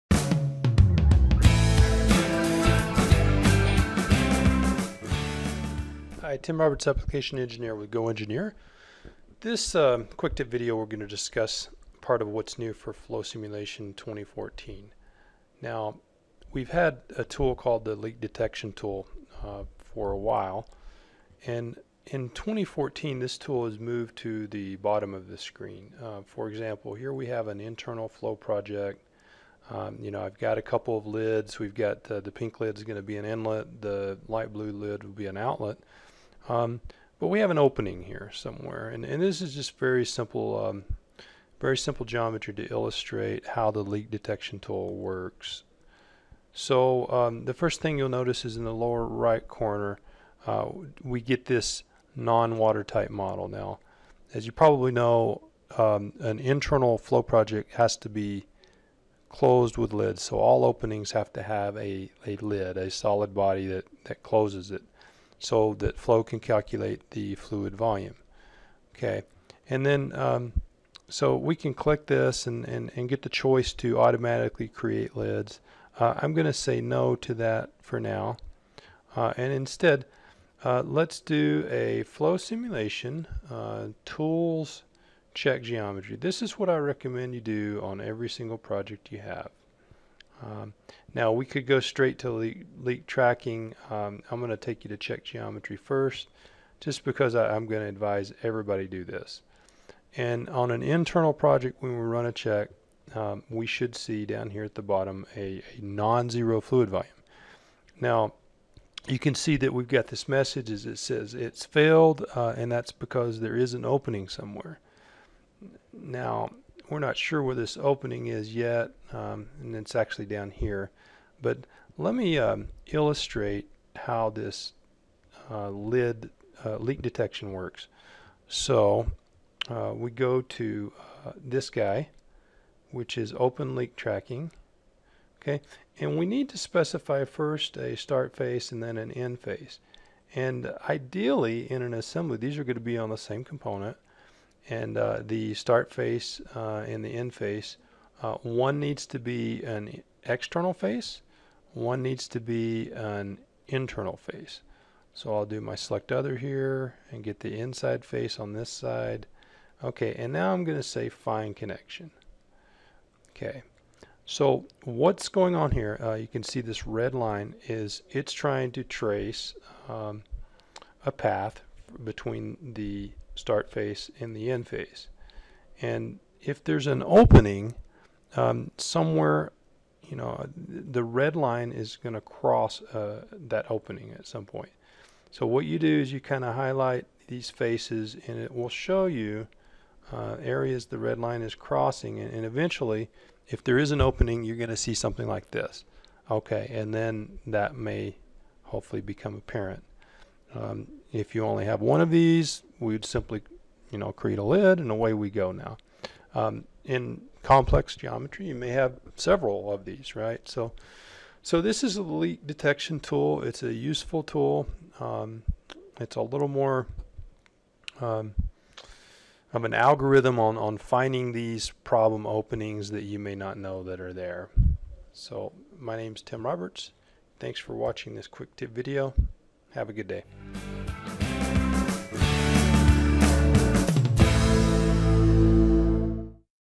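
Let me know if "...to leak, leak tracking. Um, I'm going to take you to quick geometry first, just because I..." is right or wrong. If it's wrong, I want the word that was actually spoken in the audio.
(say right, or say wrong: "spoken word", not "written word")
wrong: "check", not "quick".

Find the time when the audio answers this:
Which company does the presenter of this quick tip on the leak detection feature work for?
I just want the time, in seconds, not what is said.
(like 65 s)
7 s.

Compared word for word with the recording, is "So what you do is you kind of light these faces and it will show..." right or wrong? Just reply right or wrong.
wrong.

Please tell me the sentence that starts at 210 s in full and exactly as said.
So, so this is a leak detection tool.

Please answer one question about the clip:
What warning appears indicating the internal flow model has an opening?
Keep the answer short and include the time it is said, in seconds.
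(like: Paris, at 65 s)
Non-watertight model, at 52 s.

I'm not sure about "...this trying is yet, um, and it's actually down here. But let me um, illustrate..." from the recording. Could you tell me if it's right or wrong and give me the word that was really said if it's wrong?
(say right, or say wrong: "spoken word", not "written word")
wrong: "opening", not "trying".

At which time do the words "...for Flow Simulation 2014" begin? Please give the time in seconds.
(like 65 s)
12 s.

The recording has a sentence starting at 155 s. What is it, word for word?
So I'll do my select other here and get the inside face on this side.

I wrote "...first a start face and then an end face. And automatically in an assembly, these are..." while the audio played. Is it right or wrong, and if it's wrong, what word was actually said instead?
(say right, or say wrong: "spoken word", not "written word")
wrong: "ideally", not "automatically".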